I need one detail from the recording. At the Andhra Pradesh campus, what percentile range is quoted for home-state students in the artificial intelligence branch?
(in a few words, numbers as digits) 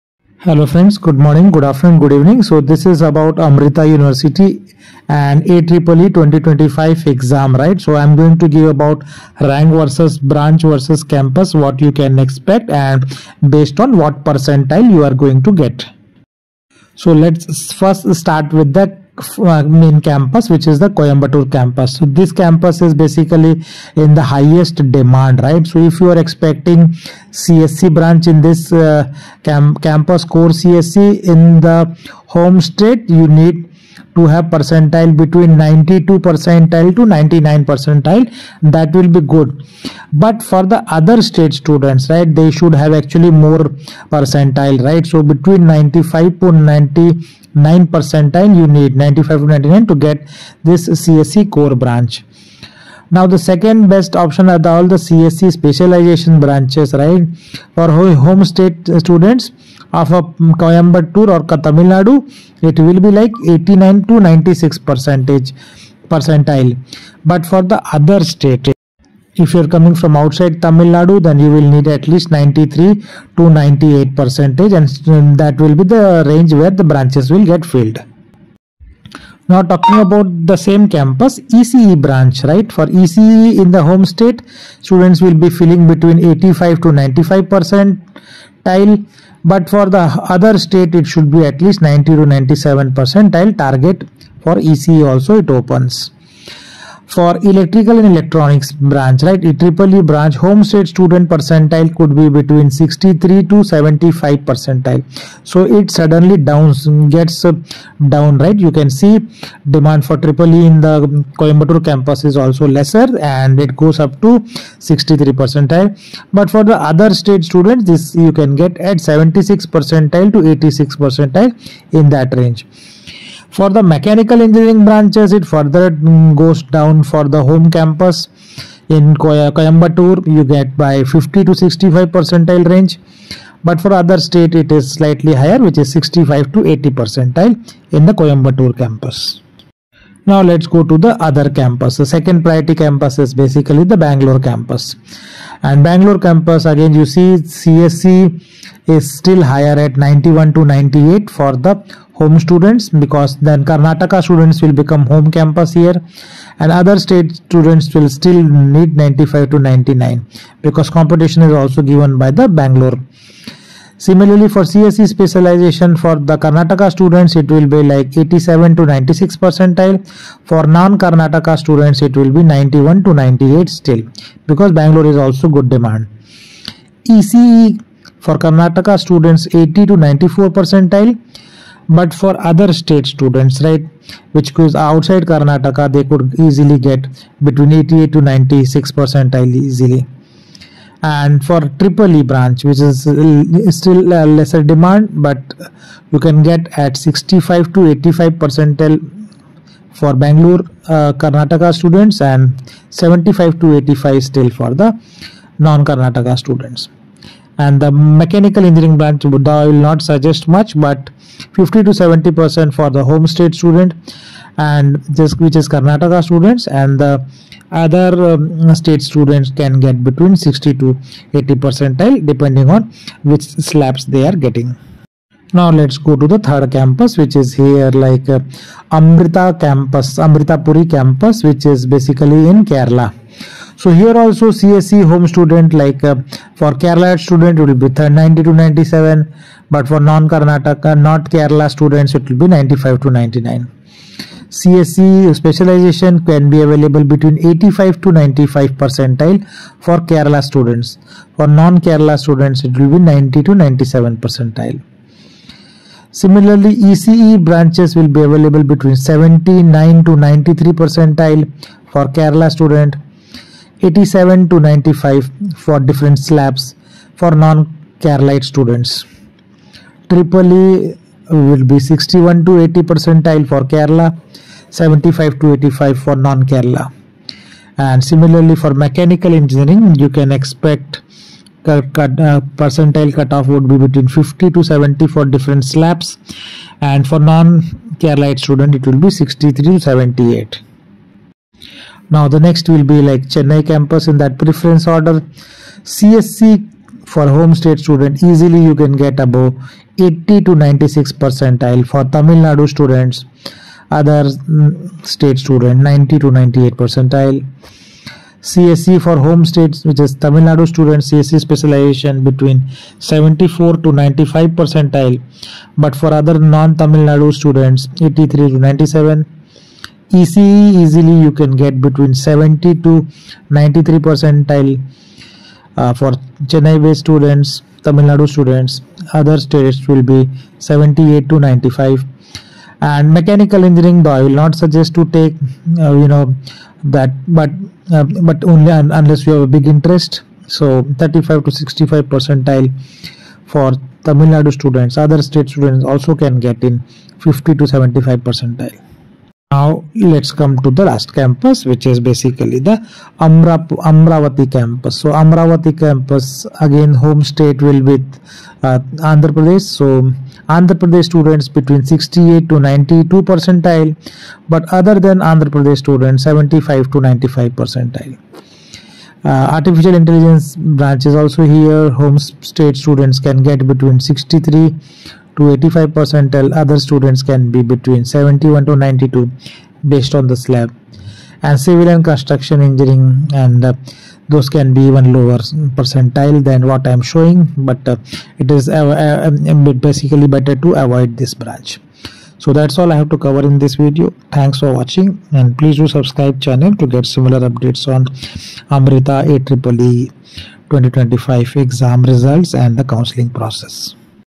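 63 to 85.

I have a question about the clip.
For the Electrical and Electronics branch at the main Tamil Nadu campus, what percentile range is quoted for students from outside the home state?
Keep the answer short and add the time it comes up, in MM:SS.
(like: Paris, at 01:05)
76 to 86 percentile, at 01:59.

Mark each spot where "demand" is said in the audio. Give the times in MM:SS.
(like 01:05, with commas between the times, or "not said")
00:24, 01:49, 02:55, 03:14.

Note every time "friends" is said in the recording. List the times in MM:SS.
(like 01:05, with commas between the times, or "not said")
00:00.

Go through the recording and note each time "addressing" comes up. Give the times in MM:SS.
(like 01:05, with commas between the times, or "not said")
not said.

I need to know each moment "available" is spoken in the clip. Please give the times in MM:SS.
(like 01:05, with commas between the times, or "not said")
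04:06, 04:18.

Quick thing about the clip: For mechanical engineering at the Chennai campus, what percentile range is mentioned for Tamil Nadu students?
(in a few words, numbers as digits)
35 to 65.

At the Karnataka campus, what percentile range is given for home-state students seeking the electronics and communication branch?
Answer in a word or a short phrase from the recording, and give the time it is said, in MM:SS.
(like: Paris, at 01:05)
80 to 94, at 02:59.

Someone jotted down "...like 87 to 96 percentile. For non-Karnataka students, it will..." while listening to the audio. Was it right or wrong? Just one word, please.
right.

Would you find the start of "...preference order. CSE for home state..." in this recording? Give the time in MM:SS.
04:54.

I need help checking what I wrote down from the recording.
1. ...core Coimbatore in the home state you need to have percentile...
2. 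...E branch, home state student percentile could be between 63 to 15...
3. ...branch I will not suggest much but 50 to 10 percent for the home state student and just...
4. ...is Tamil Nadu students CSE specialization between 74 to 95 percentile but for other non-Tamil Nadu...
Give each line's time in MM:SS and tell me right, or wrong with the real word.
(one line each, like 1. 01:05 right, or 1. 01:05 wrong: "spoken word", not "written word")
1. 00:30 wrong: "CSE", not "Coimbatore"
2. 01:39 wrong: "75", not "15"
3. 03:28 wrong: "70", not "10"
4. 05:09 right.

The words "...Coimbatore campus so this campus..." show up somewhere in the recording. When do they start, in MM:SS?
00:20.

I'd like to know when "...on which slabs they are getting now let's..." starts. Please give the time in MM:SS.
03:42.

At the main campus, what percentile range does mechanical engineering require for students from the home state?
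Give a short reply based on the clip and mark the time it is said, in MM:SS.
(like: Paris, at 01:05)
50 to 65, at 02:11.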